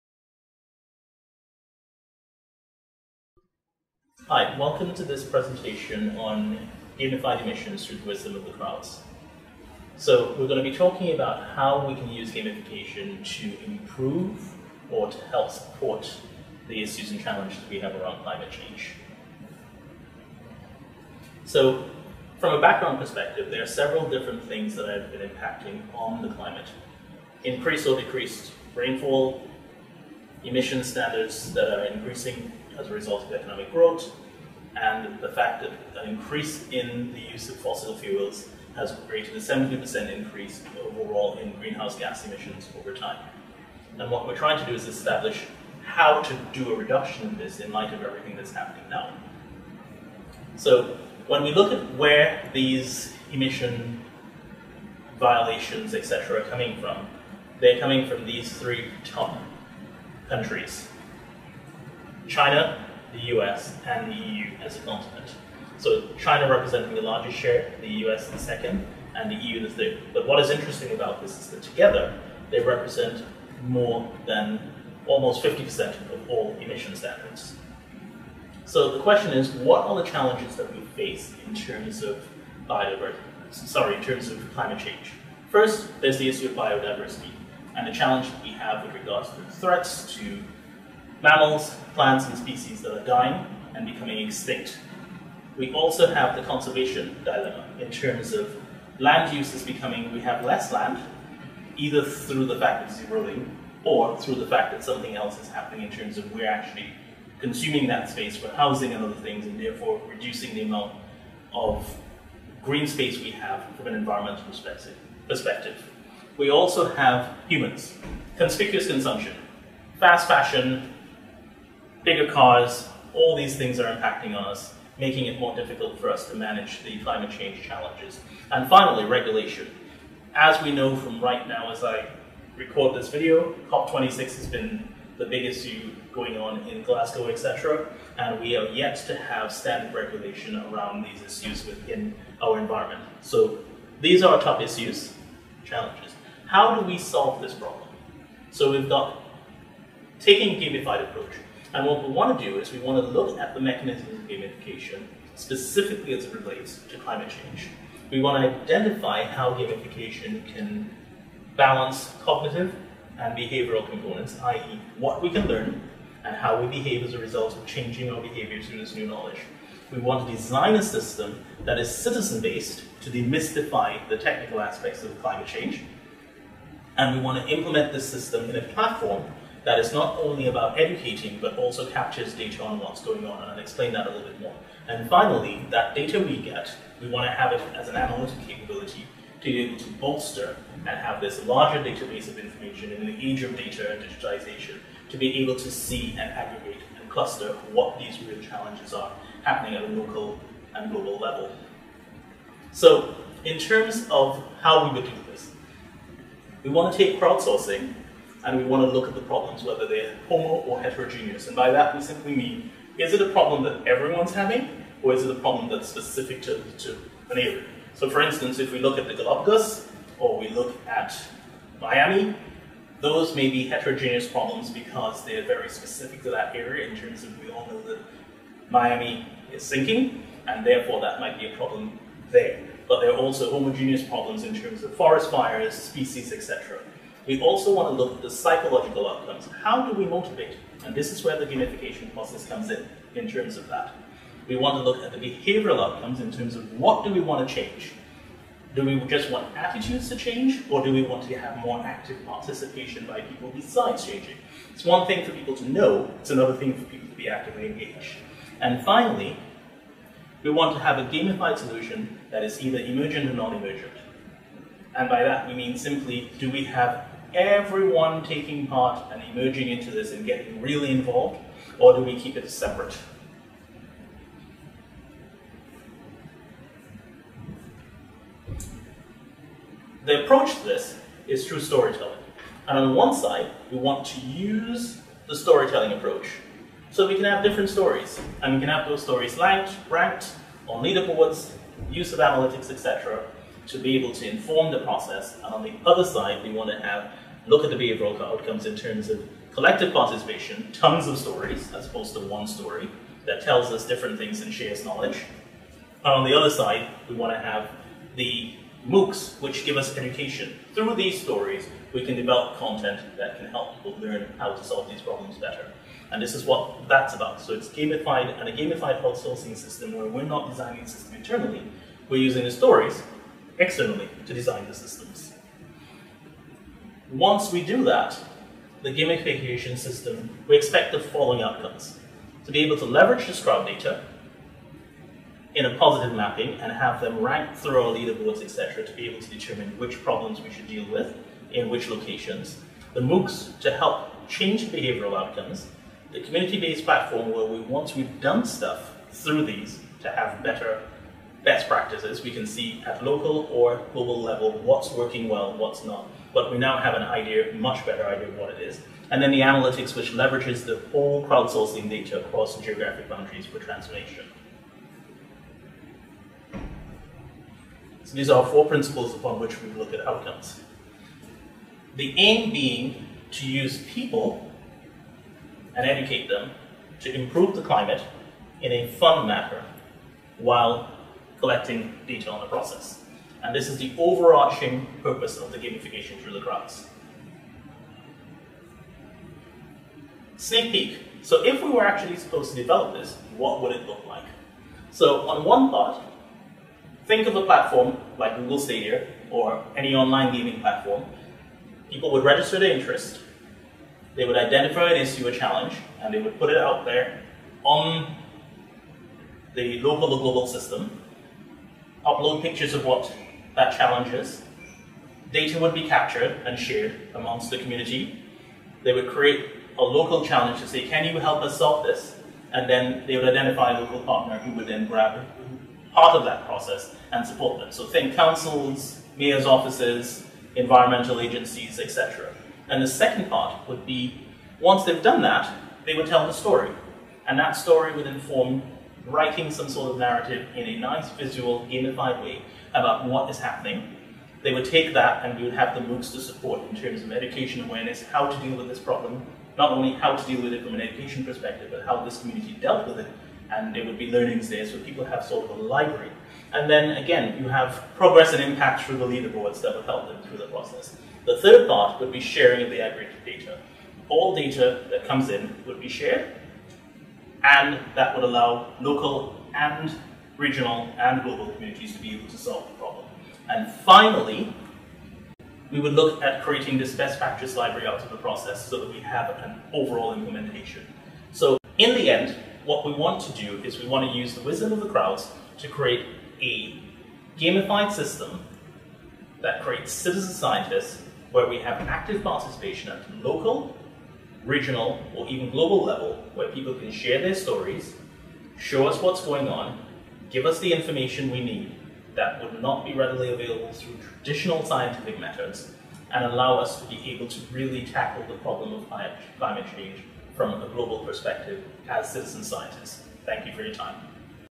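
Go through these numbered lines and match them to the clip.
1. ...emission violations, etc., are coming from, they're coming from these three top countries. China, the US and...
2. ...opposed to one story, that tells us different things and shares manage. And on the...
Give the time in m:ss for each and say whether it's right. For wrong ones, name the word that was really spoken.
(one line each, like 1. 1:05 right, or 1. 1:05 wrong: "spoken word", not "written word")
1. 0:53 right
2. 5:01 wrong: "knowledge", not "manage".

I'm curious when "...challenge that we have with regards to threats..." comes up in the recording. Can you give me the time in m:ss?
1:27.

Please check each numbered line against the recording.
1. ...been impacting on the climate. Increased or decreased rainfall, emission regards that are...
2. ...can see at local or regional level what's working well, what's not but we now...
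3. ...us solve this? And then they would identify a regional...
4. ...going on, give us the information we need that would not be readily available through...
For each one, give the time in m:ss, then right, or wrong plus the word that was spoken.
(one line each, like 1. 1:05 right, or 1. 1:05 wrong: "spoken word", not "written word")
1. 0:25 wrong: "standards", not "regards"
2. 5:52 wrong: "global", not "regional"
3. 7:01 wrong: "local", not "regional"
4. 8:19 right.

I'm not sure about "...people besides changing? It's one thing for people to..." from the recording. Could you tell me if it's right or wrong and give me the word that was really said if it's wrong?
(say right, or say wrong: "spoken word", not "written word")
right.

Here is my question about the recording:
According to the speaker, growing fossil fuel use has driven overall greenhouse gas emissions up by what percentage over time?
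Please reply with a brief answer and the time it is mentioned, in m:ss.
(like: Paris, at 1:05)
70%, at 0:39.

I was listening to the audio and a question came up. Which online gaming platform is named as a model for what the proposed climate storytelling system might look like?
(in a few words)
Google Stadia.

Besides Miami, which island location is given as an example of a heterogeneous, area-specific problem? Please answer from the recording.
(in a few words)
Galapagos.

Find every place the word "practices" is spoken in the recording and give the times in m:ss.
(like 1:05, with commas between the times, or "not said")
5:51, 7:57.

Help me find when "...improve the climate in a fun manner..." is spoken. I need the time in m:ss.
6:17.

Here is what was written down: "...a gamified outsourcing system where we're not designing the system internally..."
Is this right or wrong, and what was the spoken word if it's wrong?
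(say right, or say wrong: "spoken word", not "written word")
right.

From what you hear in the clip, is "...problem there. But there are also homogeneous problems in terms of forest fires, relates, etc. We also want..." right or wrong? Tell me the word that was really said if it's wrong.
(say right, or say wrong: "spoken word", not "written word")
wrong: "species", not "relates".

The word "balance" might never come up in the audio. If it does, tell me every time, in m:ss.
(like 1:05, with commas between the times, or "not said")
2:41.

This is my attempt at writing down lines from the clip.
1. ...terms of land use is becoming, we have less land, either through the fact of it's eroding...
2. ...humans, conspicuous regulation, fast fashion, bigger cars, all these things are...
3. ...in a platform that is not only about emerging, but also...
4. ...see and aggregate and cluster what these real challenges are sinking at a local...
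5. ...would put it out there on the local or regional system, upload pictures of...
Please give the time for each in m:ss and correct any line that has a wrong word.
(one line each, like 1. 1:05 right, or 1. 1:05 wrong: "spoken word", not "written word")
1. 1:37 right
2. 1:57 wrong: "consumption", not "regulation"
3. 2:58 wrong: "educating", not "emerging"
4. 3:15 wrong: "happening", not "sinking"
5. 6:46 wrong: "global", not "regional".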